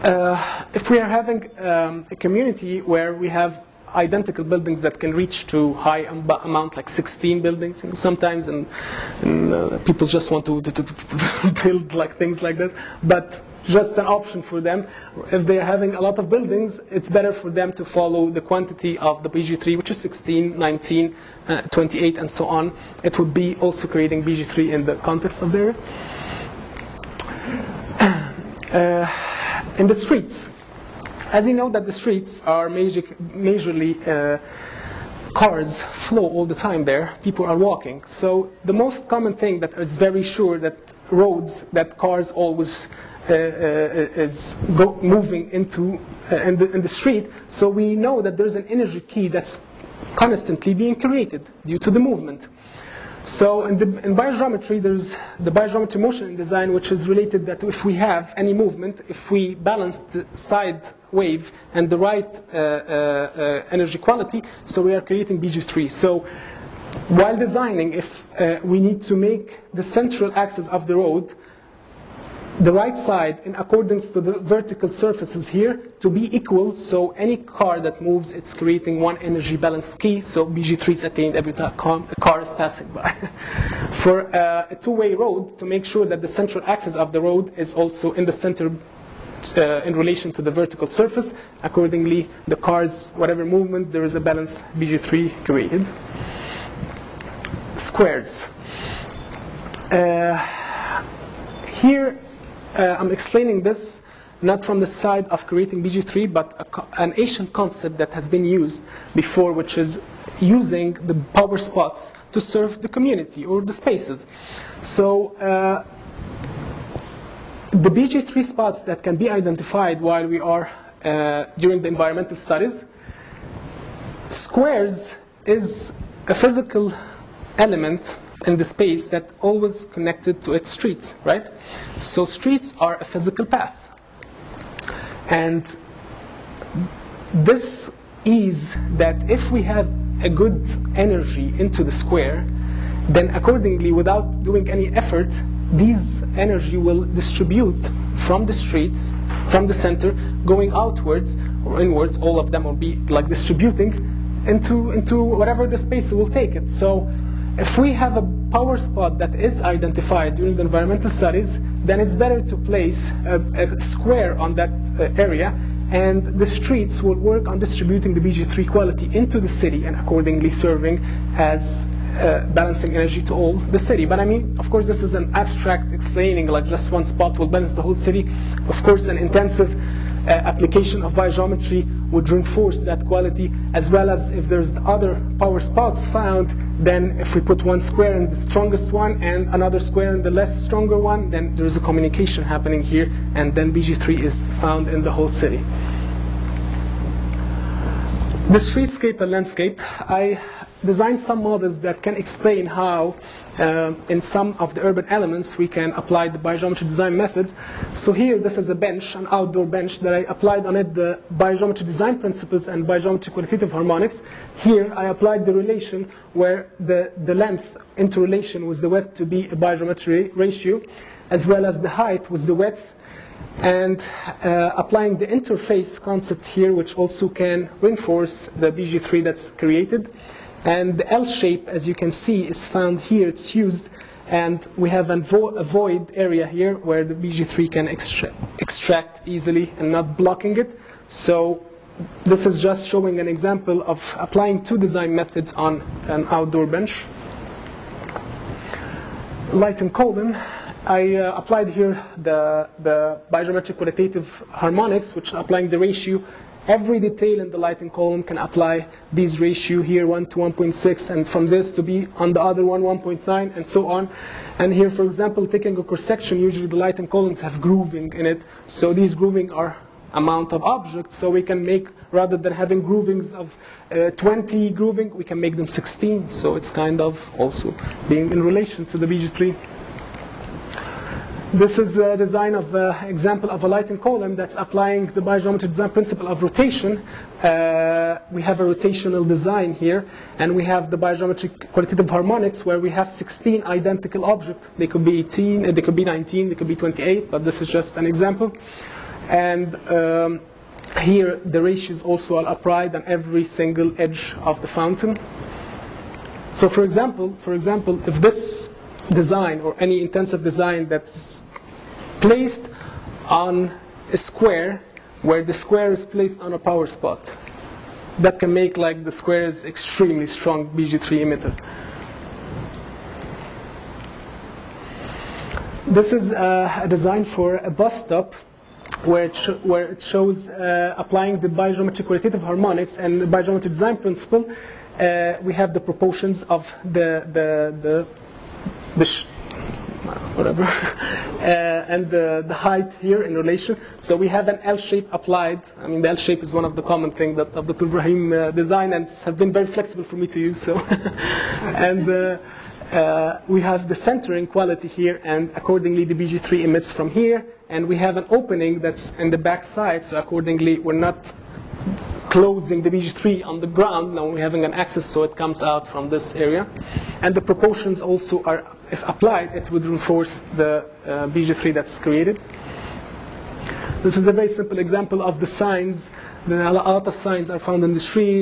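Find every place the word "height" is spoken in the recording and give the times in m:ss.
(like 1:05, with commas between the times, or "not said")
3:41, 5:42.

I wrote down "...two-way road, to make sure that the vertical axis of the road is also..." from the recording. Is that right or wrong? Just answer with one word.
wrong.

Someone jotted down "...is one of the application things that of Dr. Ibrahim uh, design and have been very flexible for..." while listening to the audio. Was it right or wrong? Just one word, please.
wrong.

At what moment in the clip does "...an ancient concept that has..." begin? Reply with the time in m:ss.
1:47.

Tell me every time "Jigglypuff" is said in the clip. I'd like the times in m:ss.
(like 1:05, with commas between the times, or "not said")
not said.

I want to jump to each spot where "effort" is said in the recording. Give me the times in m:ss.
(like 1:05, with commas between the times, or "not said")
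2:24.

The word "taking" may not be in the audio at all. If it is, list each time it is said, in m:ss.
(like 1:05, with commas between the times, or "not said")
4:25.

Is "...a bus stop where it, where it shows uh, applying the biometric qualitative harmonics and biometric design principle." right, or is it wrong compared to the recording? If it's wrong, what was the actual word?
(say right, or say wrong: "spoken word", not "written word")
right.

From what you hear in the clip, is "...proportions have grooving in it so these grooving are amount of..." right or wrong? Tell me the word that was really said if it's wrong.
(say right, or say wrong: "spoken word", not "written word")
wrong: "columns", not "proportions".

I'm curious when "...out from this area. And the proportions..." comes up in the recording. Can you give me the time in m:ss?
6:05.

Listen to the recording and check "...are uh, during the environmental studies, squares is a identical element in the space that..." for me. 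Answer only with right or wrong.
wrong.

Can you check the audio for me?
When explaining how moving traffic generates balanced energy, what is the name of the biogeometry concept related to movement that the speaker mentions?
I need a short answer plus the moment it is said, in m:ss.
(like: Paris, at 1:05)
biogeometry motion in design, at 0:55.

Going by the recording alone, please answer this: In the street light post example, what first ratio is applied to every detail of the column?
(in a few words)
1 to 1.6.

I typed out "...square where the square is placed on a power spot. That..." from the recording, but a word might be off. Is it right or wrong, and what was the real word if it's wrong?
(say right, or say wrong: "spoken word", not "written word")
right.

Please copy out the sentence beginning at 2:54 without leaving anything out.
But I mean, of course, this is an abstract explaining, like just one spot will balance the whole city.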